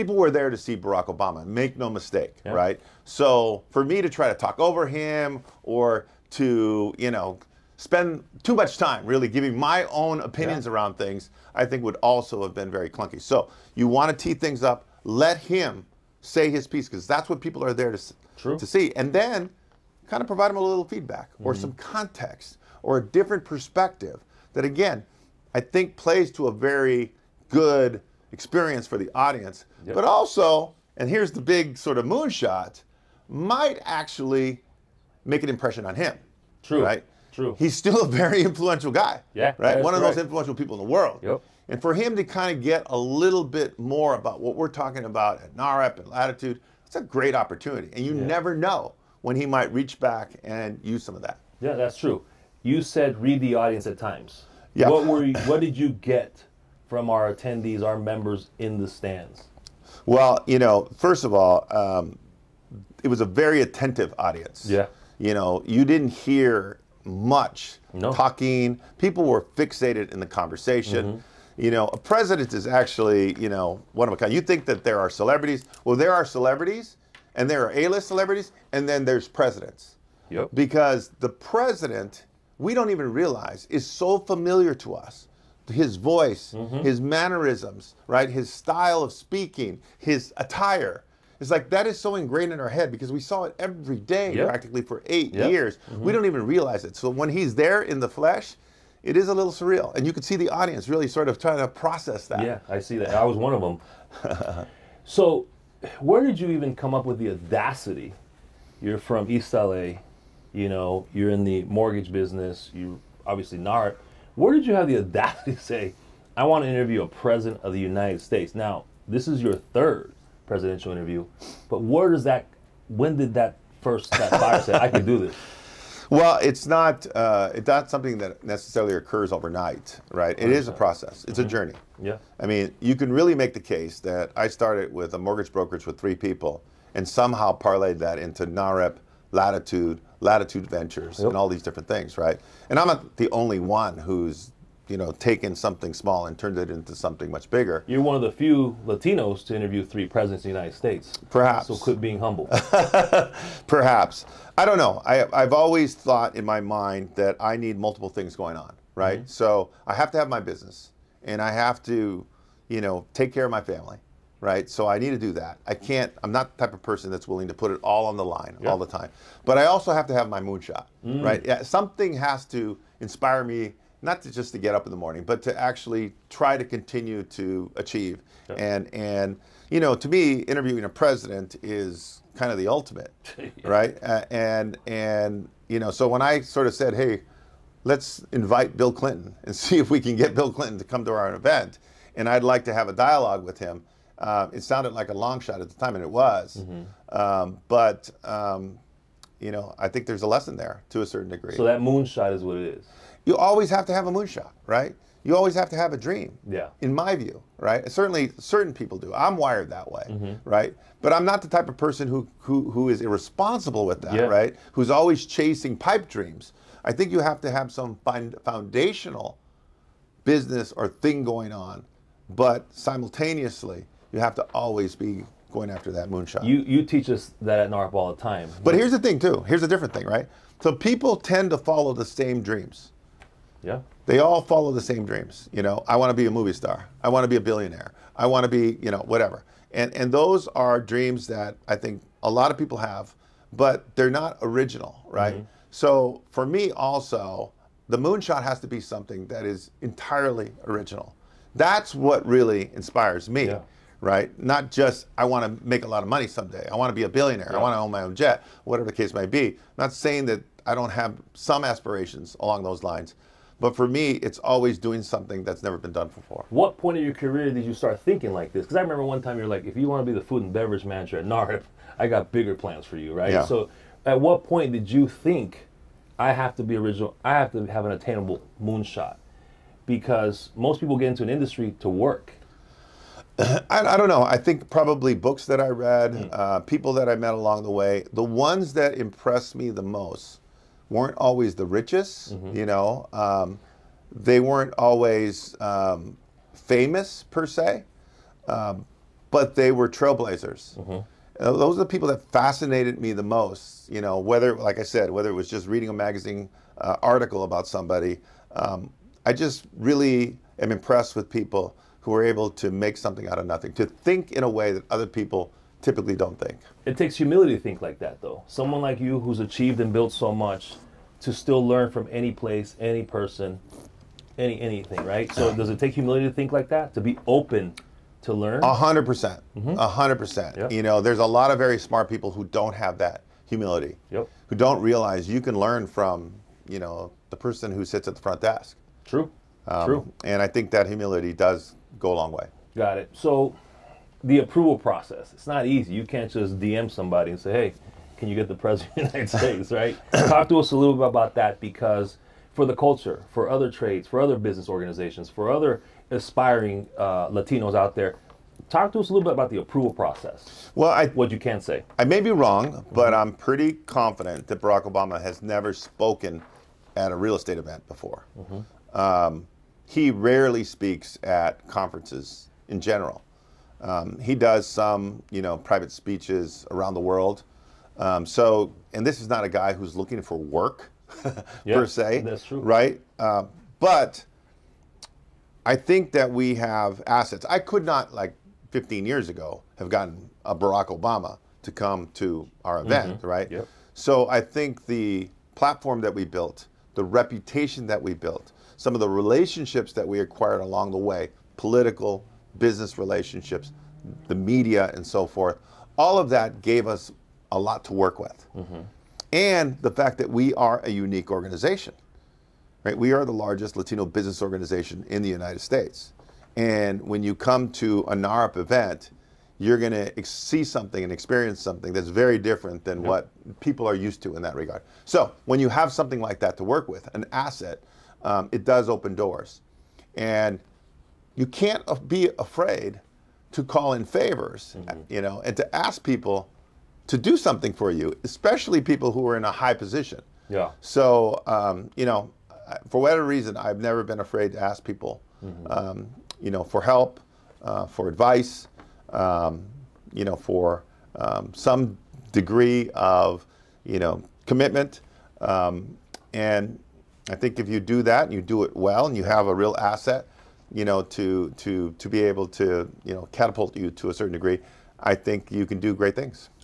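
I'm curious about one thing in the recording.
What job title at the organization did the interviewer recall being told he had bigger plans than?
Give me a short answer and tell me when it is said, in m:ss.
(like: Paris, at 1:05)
food and beverage manager, at 4:30.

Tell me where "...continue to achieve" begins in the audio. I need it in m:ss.
2:56.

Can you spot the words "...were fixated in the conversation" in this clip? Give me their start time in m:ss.
1:09.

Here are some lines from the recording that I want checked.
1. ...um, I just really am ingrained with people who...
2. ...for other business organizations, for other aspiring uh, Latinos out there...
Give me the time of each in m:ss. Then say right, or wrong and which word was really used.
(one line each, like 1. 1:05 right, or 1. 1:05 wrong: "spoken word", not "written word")
1. 5:08 wrong: "impressed", not "ingrained"
2. 5:54 right.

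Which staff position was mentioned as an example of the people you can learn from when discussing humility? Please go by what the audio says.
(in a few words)
the front desk.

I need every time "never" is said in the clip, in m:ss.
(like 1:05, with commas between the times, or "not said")
0:48, 4:25, 6:05, 7:23.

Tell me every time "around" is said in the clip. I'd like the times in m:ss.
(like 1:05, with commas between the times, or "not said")
0:10, 6:16.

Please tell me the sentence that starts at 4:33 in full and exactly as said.
So at what point did you think I have to be original?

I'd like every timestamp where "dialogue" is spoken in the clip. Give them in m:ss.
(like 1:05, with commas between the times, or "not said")
3:12.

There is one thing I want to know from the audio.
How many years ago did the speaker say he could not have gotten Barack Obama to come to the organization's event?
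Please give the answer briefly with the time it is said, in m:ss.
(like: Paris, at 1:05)
15, at 6:28.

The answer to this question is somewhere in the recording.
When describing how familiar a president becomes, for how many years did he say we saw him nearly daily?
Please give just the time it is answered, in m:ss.
1:35.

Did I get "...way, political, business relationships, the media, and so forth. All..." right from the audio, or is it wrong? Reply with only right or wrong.
right.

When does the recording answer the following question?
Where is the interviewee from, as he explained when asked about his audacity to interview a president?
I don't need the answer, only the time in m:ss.
1:49.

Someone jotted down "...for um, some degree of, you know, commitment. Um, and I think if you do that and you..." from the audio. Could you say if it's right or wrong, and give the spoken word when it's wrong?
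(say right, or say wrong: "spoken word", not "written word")
right.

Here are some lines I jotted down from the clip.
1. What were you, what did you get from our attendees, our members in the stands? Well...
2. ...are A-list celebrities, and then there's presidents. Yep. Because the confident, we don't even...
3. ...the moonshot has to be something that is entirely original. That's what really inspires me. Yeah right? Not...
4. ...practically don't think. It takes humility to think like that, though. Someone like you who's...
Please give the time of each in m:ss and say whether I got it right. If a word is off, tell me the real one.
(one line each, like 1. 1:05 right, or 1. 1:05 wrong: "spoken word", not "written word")
1. 0:54 right
2. 1:17 wrong: "president", not "confident"
3. 4:07 right
4. 5:15 wrong: "typically", not "practically".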